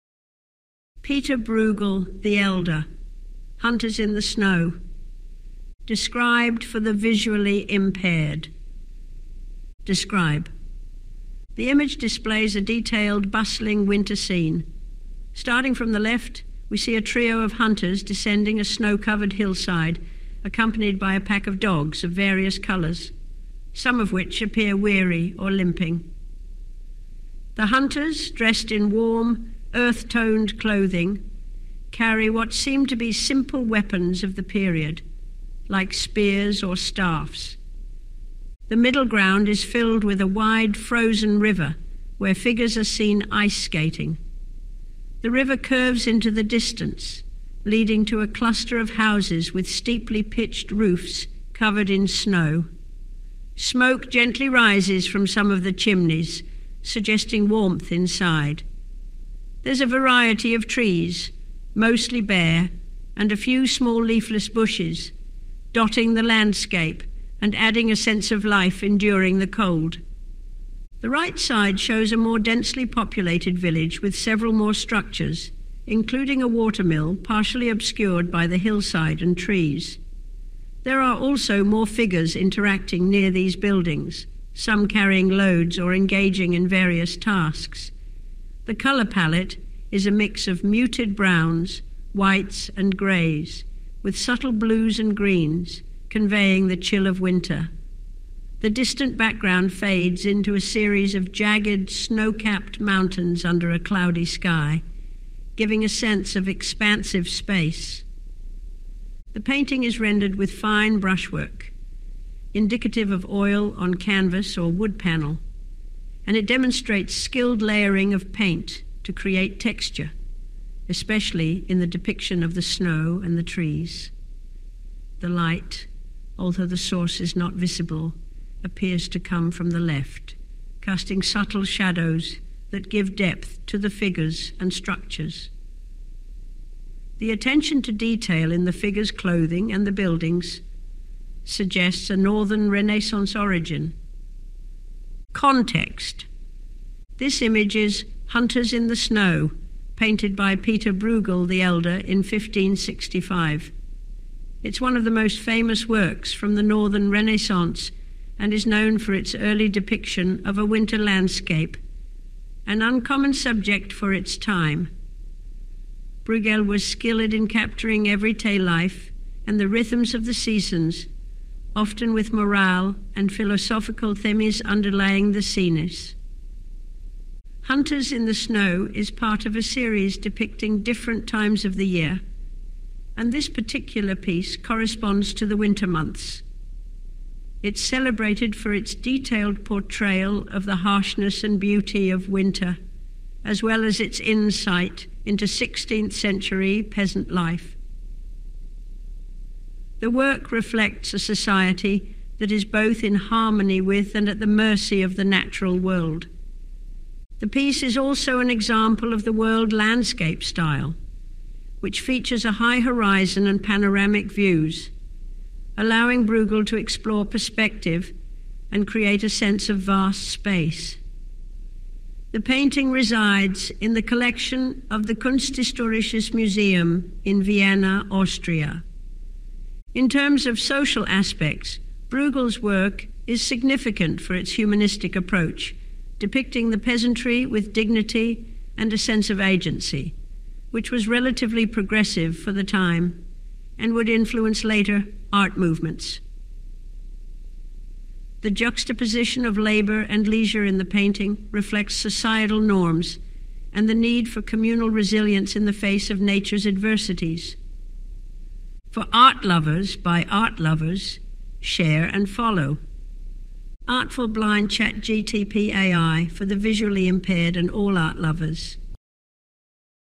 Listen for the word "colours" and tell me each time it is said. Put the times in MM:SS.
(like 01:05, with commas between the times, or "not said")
00:22, 01:28.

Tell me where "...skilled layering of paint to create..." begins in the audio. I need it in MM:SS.
01:57.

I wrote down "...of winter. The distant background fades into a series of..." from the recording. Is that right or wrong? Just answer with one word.
right.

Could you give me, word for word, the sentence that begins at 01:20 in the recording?
There are also more figures interacting near these buildings, some carrying loads or engaging in various tasks.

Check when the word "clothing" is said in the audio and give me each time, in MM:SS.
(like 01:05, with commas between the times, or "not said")
00:30, 02:19.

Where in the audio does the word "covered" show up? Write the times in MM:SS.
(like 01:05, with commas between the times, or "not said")
00:18, 00:51.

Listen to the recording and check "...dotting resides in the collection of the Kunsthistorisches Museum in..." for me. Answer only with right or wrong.
wrong.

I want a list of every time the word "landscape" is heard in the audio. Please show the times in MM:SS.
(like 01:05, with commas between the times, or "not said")
01:06, 02:40, 03:29.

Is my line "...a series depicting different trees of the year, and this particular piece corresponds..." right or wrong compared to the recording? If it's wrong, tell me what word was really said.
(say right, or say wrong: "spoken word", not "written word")
wrong: "times", not "trees".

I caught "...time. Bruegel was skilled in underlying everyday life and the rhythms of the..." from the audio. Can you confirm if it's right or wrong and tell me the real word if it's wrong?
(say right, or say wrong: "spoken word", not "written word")
wrong: "capturing", not "underlying".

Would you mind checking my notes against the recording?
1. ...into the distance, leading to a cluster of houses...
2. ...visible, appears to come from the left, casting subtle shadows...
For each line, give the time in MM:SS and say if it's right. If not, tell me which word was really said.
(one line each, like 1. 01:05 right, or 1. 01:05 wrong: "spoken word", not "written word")
1. 00:46 right
2. 02:07 right.